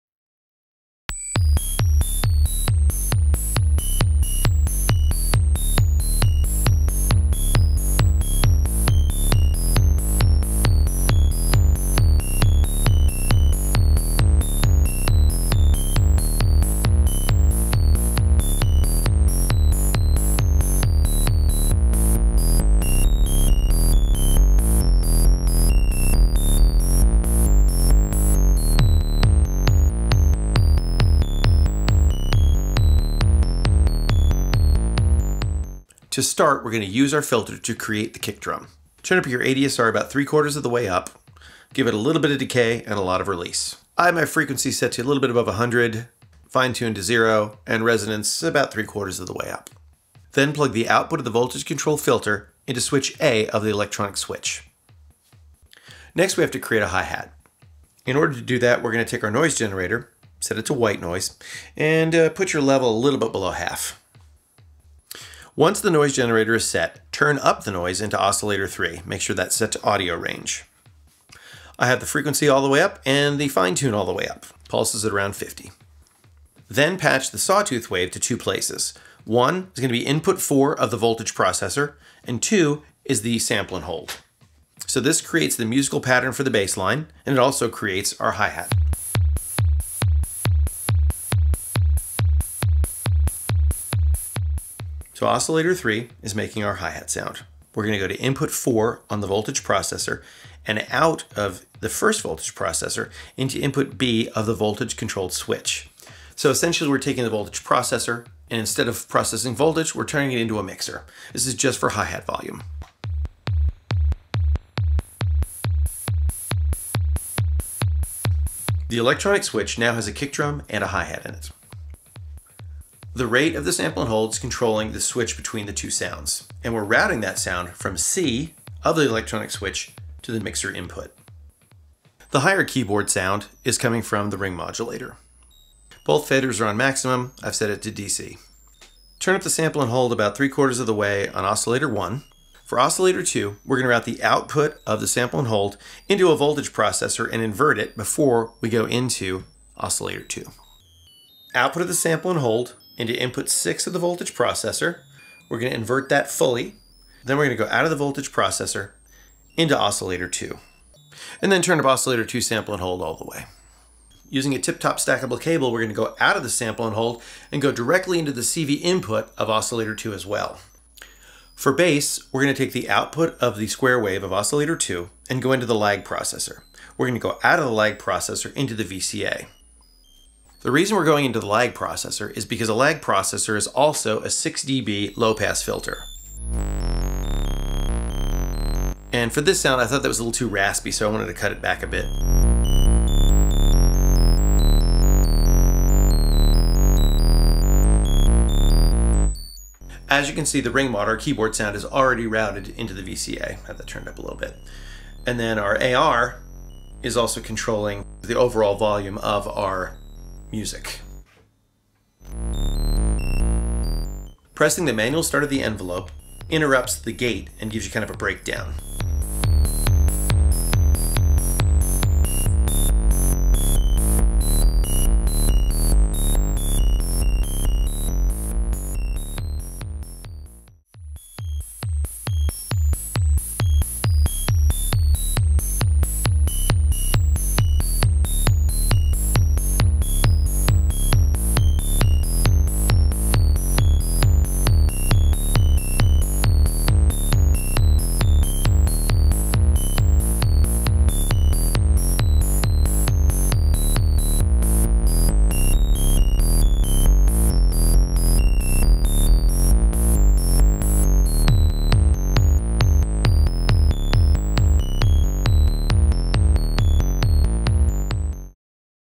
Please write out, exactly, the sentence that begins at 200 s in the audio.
As you can see, the ring mod, our keyboard sound, is already routed into the VCA.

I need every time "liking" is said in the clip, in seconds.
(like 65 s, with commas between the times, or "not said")
not said.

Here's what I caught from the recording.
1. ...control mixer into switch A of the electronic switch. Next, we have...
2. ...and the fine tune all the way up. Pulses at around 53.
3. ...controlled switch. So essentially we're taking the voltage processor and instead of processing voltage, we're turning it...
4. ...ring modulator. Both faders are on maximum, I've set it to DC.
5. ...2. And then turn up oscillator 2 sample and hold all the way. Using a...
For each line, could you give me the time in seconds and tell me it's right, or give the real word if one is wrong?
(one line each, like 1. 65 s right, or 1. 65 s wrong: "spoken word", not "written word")
1. 51 s wrong: "filter", not "mixer"
2. 73 s wrong: "50", not "53"
3. 104 s right
4. 134 s right
5. 160 s right.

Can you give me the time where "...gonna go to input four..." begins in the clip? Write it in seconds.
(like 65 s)
97 s.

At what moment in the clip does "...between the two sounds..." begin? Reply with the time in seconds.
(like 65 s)
125 s.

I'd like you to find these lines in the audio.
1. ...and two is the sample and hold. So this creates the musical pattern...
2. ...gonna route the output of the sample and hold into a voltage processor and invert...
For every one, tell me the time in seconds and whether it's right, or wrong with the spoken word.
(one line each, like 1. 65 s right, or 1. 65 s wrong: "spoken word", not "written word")
1. 82 s right
2. 143 s right.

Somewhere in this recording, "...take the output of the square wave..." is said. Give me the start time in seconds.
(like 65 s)
172 s.